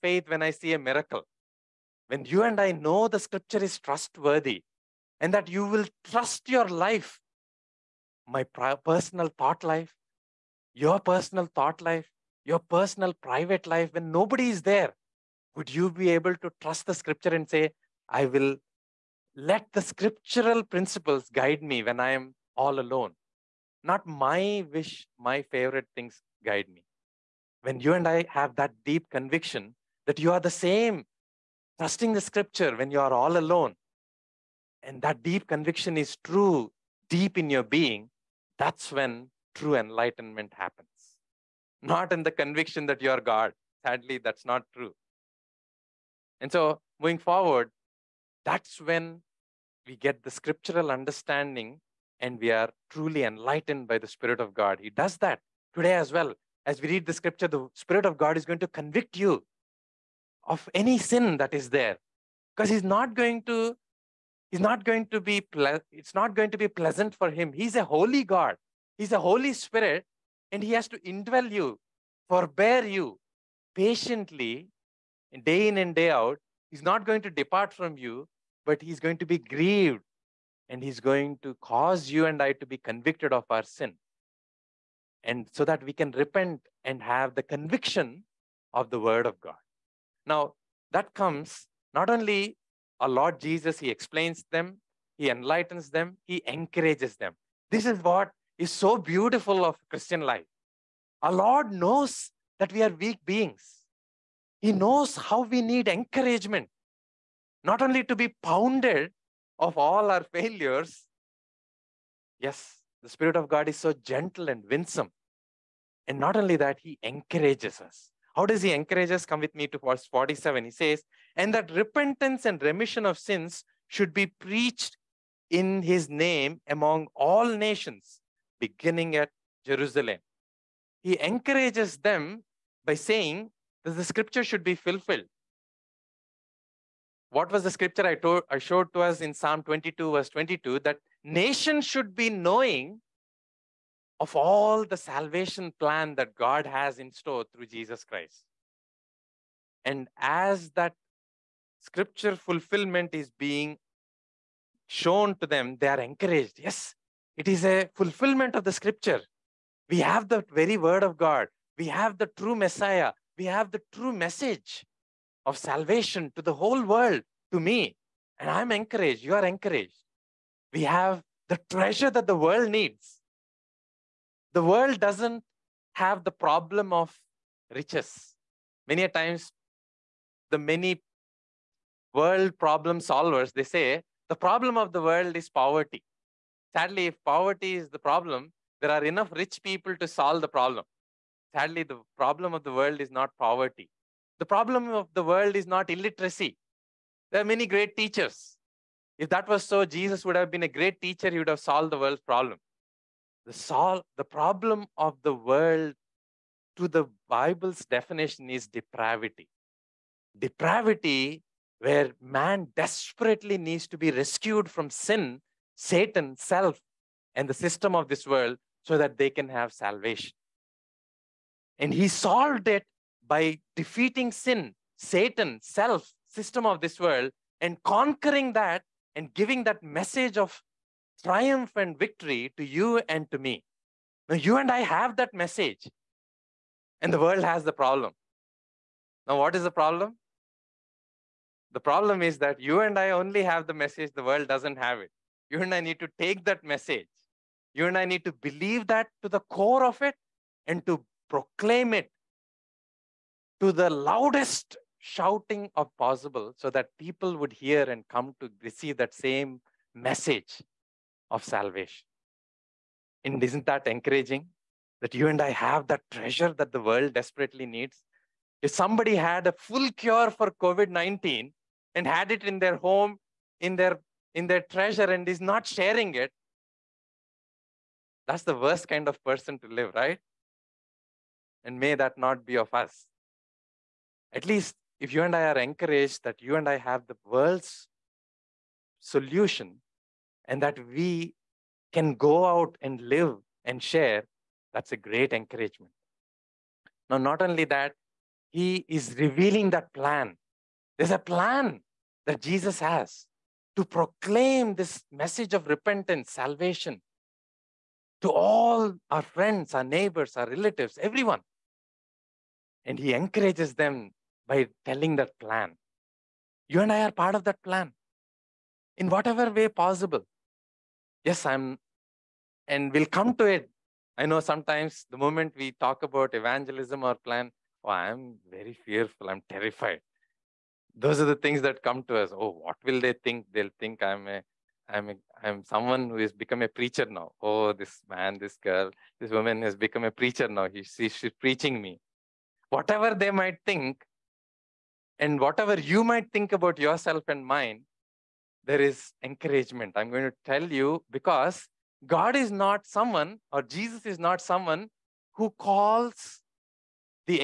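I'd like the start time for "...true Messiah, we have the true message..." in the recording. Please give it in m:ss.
2:42.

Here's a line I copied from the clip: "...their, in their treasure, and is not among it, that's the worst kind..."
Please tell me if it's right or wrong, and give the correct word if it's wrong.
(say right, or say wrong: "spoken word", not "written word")
wrong: "sharing", not "among".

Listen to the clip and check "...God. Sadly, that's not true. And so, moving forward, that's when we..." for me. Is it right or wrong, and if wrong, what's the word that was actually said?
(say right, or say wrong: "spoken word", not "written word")
right.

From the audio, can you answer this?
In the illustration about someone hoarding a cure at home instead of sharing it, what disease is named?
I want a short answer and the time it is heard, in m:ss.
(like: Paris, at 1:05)
COVID-19, at 4:30.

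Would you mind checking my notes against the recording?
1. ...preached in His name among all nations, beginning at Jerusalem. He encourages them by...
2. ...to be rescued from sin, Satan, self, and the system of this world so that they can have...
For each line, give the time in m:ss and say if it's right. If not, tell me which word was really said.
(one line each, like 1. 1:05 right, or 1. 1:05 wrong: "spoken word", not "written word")
1. 2:04 right
2. 3:33 right.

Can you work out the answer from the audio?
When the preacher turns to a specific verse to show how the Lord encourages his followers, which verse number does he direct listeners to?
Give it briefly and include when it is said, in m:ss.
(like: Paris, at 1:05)
47, at 1:59.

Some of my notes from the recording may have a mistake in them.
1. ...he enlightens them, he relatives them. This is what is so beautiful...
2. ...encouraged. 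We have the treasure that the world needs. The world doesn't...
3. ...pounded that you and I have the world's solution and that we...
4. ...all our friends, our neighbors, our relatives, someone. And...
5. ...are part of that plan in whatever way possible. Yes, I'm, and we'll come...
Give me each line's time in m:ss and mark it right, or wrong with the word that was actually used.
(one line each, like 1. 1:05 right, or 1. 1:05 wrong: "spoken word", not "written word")
1. 1:35 wrong: "encourages", not "relatives"
2. 2:49 right
3. 4:45 wrong: "encouraged", not "pounded"
4. 5:08 wrong: "everyone", not "someone"
5. 5:17 right.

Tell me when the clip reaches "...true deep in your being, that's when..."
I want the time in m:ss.
0:36.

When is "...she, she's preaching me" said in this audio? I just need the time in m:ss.
5:40.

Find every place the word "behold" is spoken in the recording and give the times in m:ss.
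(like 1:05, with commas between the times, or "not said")
not said.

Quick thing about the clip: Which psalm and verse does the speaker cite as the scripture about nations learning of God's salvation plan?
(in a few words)
Psalm 22:22.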